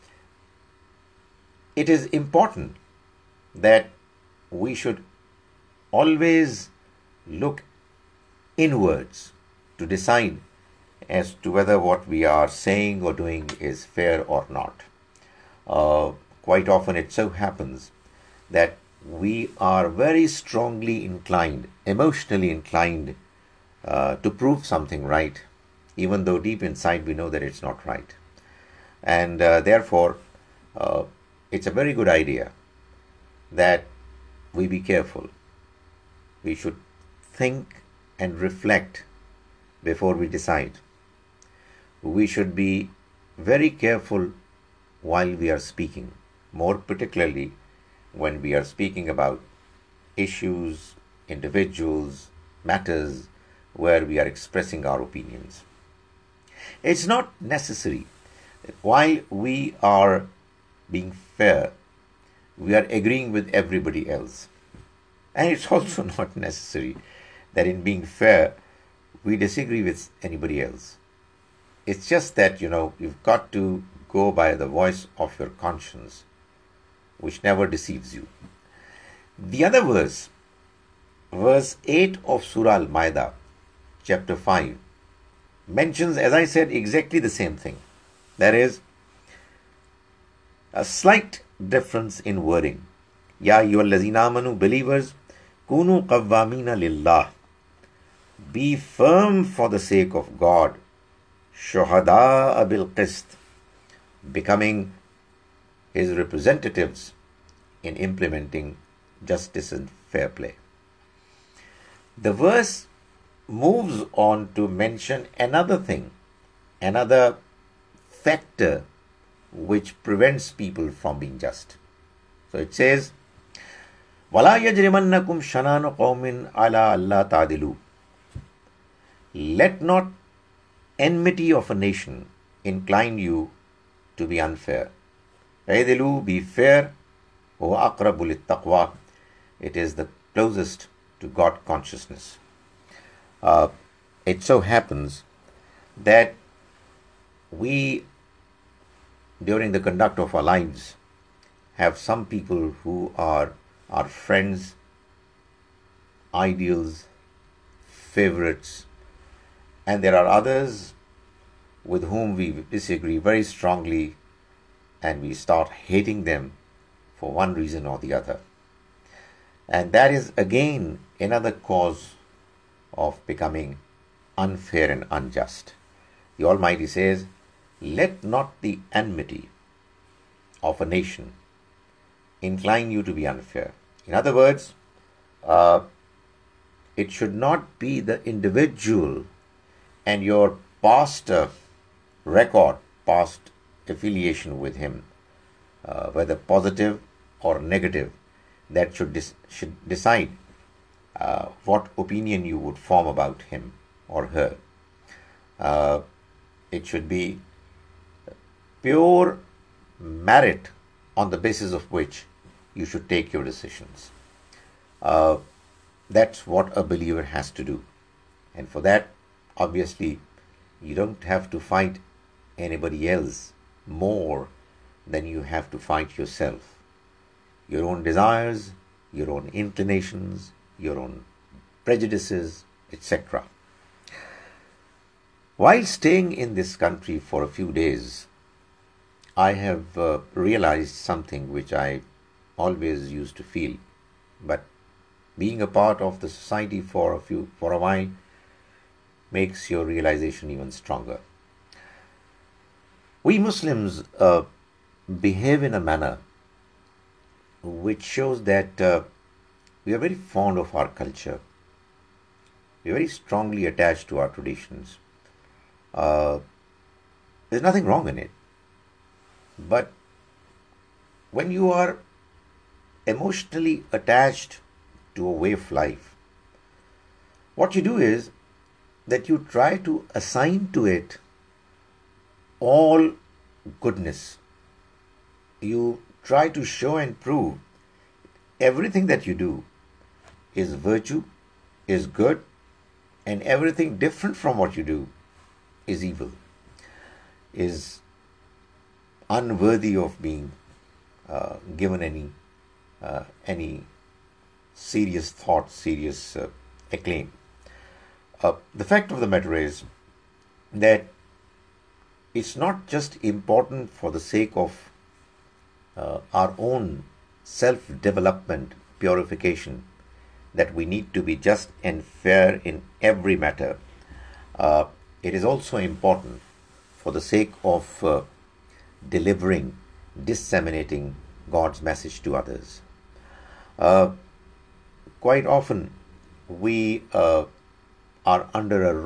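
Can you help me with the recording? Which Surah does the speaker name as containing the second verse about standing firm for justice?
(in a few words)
Al Maida.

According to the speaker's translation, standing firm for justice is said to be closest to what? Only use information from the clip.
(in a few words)
God consciousness.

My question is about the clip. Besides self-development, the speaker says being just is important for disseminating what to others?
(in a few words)
God's message.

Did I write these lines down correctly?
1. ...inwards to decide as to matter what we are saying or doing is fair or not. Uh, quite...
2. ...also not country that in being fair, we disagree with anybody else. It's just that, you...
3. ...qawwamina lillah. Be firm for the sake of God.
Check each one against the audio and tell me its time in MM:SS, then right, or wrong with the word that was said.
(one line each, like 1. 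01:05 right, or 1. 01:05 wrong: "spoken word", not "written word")
1. 00:08 wrong: "whether", not "matter"
2. 01:05 wrong: "necessary", not "country"
3. 01:36 right.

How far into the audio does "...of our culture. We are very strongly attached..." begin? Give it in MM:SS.
04:20.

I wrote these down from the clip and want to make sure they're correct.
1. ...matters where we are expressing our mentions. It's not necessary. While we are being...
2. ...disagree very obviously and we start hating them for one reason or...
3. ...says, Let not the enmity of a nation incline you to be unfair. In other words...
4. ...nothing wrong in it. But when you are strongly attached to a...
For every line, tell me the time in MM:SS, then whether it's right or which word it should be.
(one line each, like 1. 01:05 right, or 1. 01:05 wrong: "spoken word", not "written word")
1. 00:52 wrong: "opinions", not "mentions"
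2. 02:42 wrong: "strongly", not "obviously"
3. 02:56 right
4. 04:27 wrong: "emotionally", not "strongly".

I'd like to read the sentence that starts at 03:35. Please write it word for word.
Uh, that's what a believer has to do.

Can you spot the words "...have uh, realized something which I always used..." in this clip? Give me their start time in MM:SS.
03:59.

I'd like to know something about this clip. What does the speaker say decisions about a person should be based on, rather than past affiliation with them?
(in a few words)
Pure merit.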